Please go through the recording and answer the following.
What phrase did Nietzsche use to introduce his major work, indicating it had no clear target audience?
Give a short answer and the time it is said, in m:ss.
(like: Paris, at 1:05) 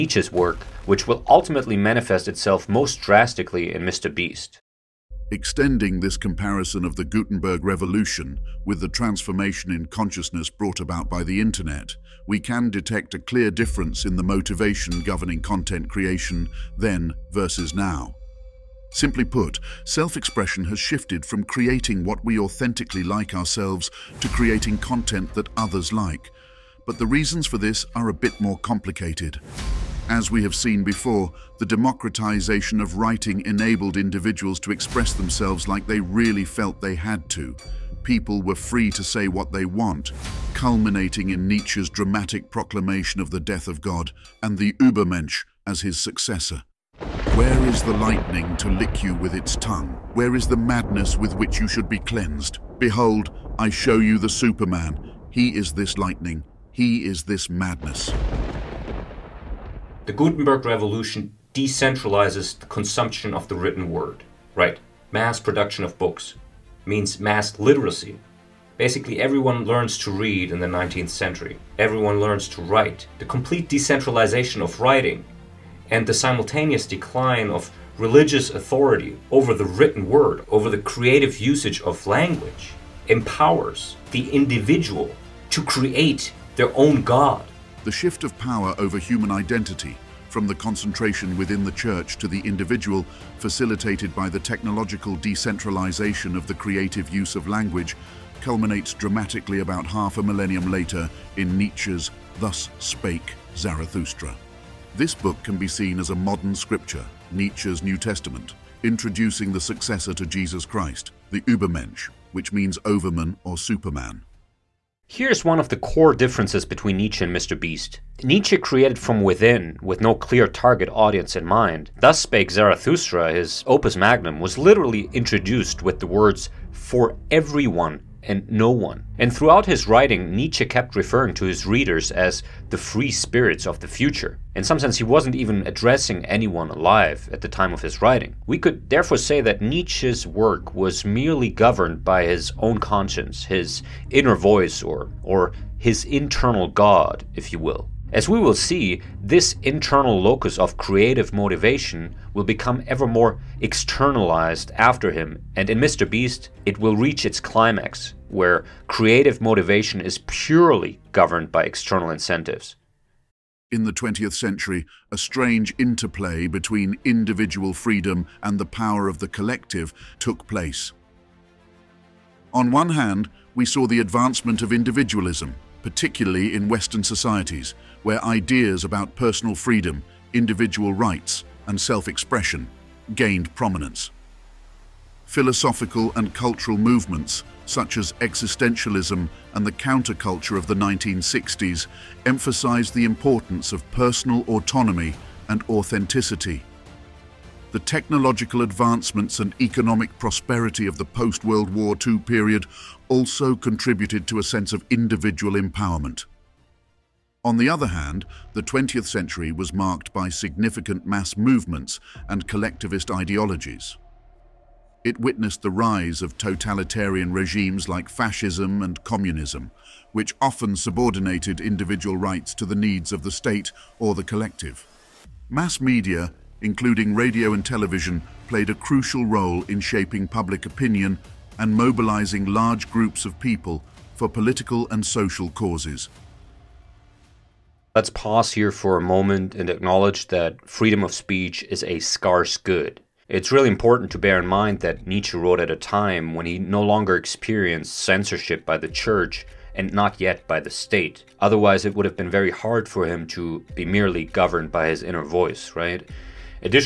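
for everyone and no one, at 2:06.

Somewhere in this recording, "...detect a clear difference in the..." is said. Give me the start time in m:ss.
0:12.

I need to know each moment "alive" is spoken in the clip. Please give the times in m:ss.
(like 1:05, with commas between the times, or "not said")
2:16.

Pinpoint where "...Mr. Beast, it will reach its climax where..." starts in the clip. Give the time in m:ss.
2:35.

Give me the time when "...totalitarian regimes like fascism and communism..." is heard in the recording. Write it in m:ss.
3:36.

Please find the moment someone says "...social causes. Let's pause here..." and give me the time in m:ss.
3:55.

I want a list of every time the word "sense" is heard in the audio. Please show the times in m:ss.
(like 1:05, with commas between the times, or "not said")
2:14, 3:24.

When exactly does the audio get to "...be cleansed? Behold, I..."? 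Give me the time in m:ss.
0:51.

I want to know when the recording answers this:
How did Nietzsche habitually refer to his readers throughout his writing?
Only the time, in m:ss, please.
2:12.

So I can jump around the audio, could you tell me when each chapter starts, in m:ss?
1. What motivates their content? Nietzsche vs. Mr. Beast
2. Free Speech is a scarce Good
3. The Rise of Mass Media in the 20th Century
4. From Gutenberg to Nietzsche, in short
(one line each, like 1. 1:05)
1. 1:56
2. 3:56
3. 2:45
4. 0:08.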